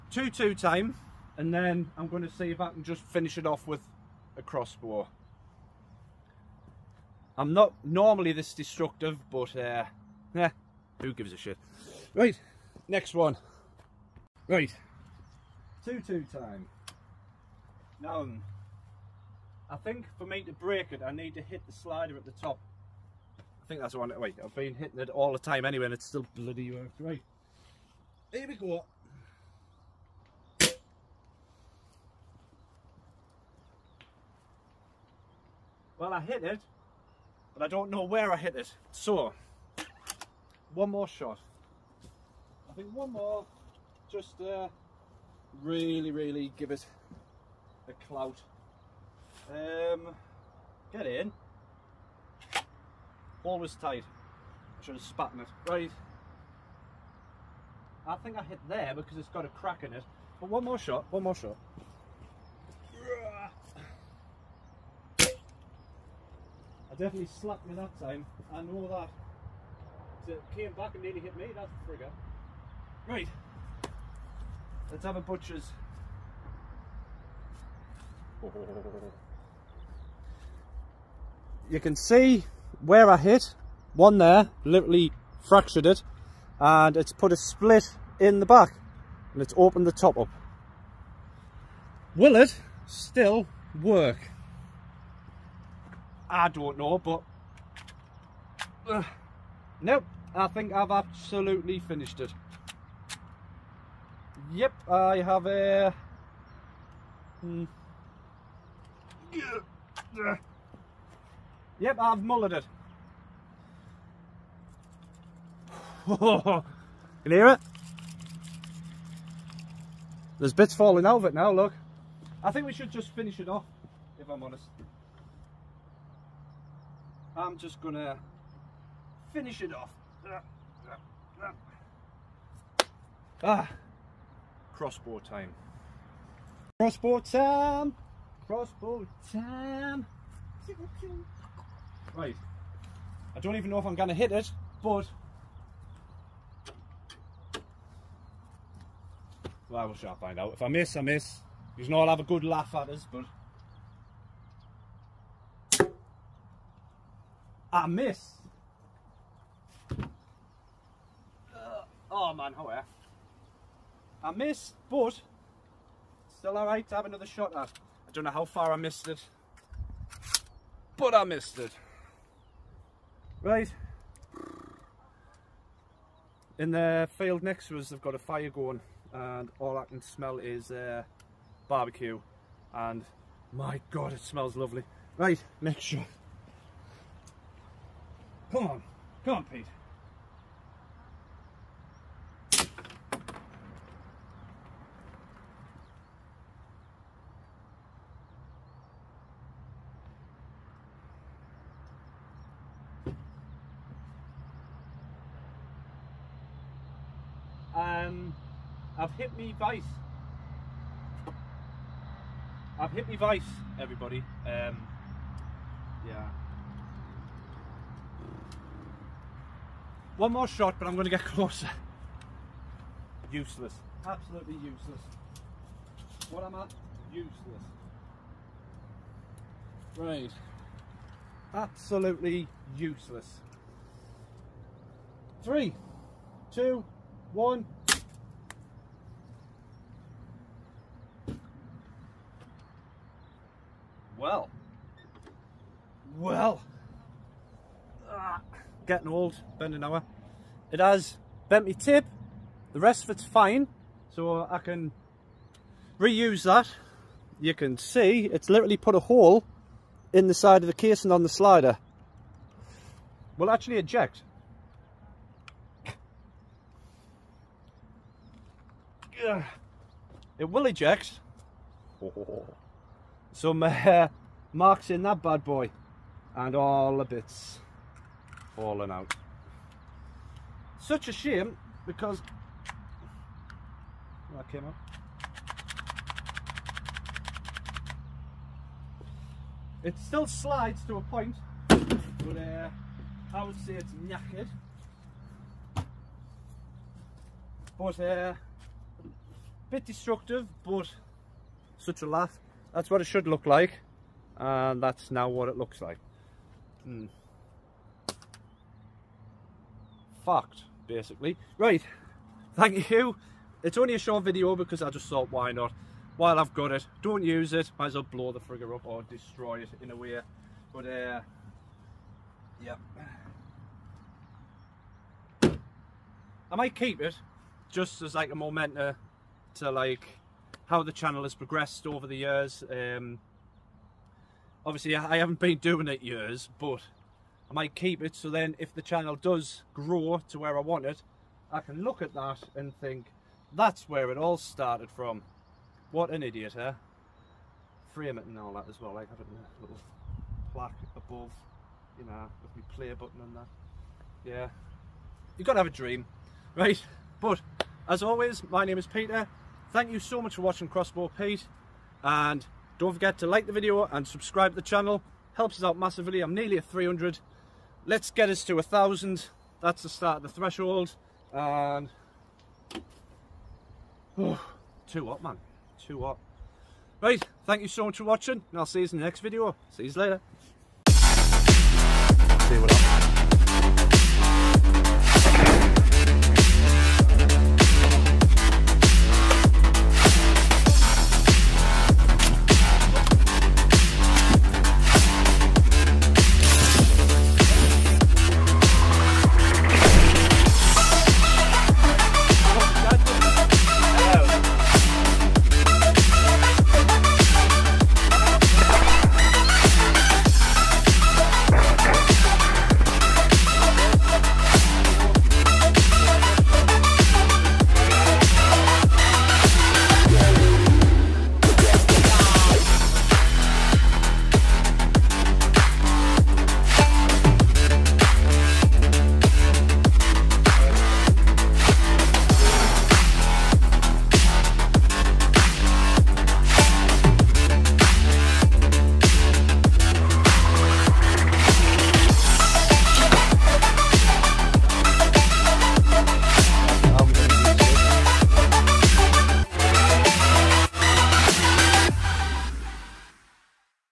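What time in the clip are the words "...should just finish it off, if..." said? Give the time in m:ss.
2:02.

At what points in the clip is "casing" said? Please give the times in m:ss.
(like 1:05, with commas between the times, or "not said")
4:20.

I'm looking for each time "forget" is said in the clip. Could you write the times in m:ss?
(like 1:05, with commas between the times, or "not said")
6:02.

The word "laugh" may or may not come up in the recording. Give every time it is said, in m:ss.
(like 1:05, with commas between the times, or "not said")
2:32, 5:02.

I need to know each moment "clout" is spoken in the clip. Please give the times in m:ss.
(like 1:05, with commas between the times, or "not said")
0:48.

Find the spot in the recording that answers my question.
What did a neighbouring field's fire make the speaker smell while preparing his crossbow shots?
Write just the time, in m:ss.
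3:01.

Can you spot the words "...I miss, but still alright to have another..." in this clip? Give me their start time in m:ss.
2:44.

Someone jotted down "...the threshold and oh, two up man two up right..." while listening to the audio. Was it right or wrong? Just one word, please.
right.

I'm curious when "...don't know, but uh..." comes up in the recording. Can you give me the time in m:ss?
1:36.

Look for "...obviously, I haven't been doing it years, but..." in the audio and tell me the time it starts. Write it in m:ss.
5:34.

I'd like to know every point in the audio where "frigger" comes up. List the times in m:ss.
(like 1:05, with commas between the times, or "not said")
1:11, 5:18.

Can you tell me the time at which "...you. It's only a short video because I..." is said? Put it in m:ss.
5:12.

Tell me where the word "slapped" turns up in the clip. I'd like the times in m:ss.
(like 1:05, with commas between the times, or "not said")
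1:07.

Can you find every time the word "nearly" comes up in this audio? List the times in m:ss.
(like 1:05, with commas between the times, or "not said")
1:11, 6:06.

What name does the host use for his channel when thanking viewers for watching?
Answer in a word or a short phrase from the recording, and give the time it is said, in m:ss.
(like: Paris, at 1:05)
Crossbow Pete, at 6:00.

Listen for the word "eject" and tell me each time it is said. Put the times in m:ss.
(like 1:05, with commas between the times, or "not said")
4:23, 4:30.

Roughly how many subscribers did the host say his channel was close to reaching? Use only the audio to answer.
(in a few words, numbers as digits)
300.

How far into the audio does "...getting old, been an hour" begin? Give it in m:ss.
4:08.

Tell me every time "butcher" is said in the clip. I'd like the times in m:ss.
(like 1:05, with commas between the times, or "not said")
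1:15.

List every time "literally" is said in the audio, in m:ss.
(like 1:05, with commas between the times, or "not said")
1:24, 4:18.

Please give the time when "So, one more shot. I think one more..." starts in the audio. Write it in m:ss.
0:38.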